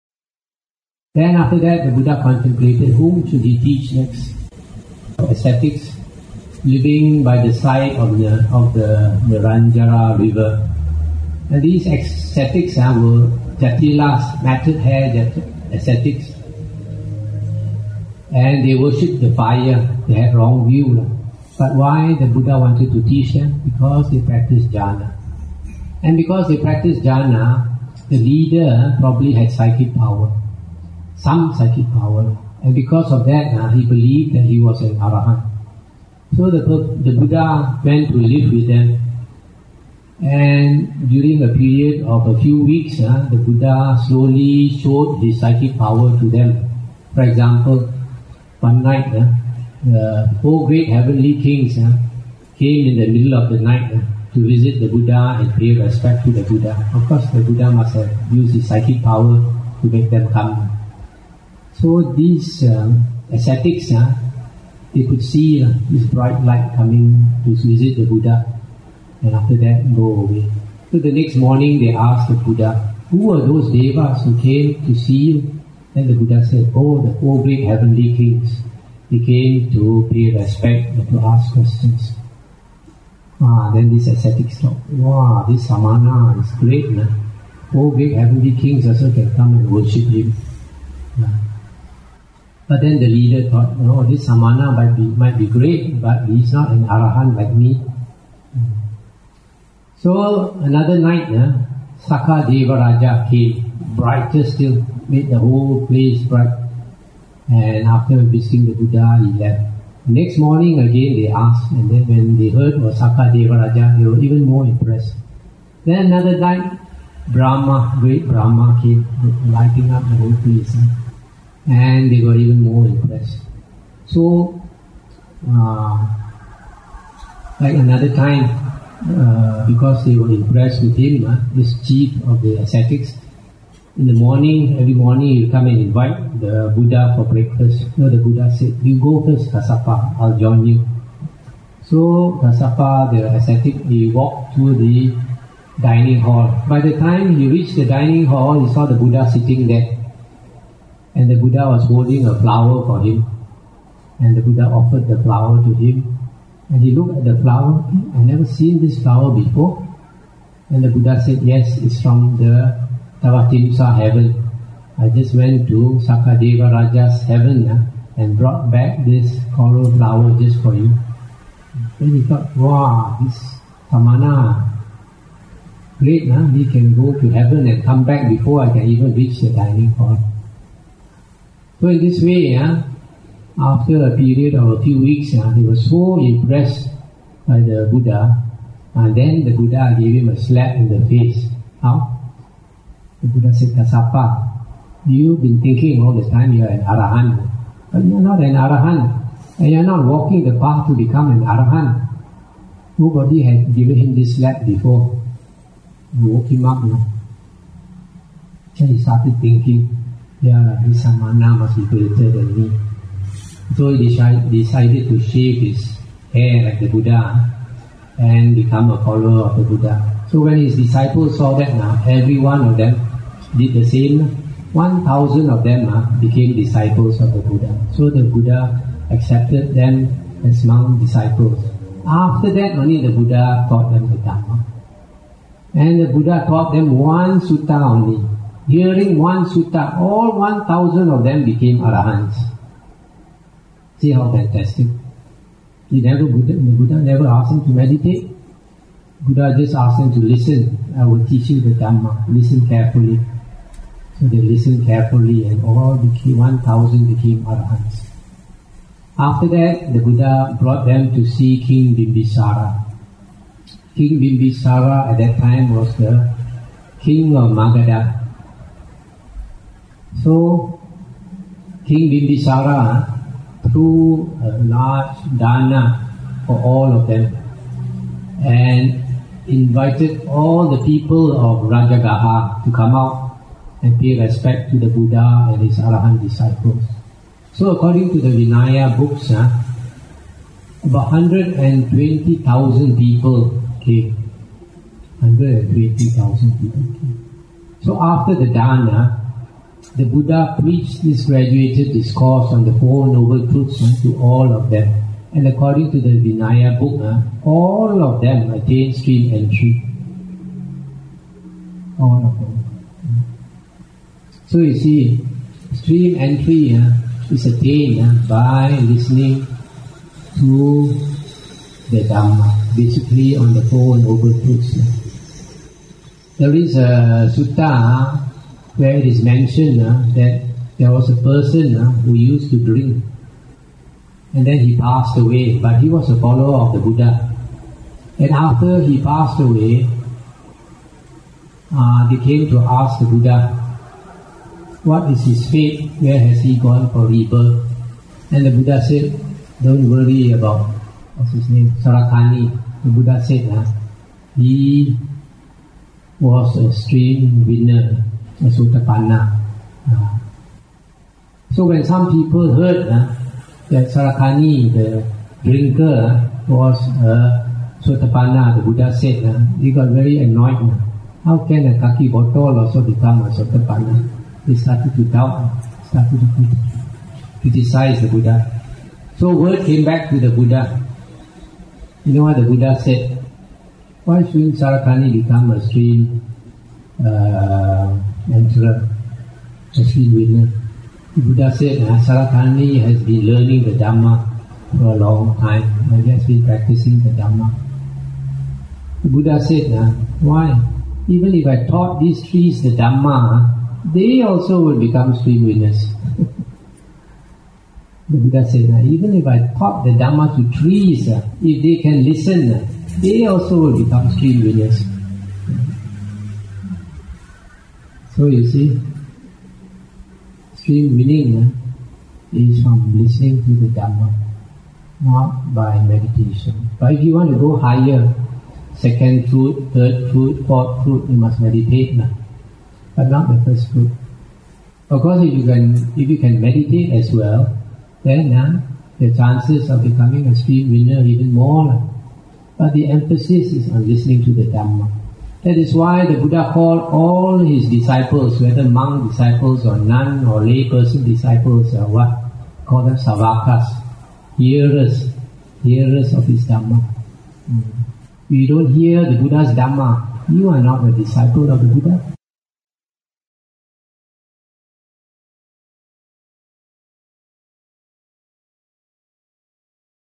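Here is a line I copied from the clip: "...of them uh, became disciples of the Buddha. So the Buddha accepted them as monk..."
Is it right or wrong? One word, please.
right.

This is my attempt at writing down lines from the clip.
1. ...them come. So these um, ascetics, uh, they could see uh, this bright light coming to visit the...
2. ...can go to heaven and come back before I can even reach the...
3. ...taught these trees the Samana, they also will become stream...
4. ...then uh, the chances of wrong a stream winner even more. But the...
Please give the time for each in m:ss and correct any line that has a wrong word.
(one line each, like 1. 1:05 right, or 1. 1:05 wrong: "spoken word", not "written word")
1. 1:00 right
2. 2:56 right
3. 6:41 wrong: "Dhamma", not "Samana"
4. 7:18 wrong: "becoming", not "wrong".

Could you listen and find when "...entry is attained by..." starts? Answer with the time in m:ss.
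5:16.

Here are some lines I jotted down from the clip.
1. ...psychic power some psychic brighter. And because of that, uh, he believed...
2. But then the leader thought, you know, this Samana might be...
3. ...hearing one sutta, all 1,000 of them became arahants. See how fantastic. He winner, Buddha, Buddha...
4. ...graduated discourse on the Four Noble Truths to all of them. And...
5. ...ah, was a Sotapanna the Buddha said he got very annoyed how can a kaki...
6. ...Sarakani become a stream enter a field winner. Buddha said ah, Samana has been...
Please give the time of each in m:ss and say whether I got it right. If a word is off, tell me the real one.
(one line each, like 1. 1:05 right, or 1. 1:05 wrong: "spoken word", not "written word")
1. 0:29 wrong: "power", not "brighter"
2. 1:32 right
3. 3:58 wrong: "never", not "winner"
4. 5:01 right
5. 6:06 right
6. 6:24 wrong: "Sarakani", not "Samana".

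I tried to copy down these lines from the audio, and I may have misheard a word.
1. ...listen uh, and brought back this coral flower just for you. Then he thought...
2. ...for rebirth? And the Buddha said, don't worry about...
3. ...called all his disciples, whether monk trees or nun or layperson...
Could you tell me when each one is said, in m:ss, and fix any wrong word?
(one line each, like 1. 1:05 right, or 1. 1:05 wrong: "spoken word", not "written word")
1. 2:47 wrong: "heaven", not "listen"
2. 5:46 right
3. 7:26 wrong: "disciples", not "trees".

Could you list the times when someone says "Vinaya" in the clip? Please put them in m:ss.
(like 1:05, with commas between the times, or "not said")
4:48, 5:06.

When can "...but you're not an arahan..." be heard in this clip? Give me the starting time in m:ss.
3:17.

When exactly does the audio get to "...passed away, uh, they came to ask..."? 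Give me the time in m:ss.
5:39.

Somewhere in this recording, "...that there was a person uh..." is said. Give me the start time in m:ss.
5:30.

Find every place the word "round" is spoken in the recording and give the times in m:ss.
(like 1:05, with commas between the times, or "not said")
not said.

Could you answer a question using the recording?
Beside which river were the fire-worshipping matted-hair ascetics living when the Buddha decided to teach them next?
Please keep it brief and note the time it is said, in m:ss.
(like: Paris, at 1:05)
Niranjara, at 0:09.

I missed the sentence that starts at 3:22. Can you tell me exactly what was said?
Nobody had given him this slap before.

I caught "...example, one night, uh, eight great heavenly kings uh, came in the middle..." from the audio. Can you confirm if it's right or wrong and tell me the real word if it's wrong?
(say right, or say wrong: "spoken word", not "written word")
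wrong: "four", not "eight".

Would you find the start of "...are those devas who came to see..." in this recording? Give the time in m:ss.
1:13.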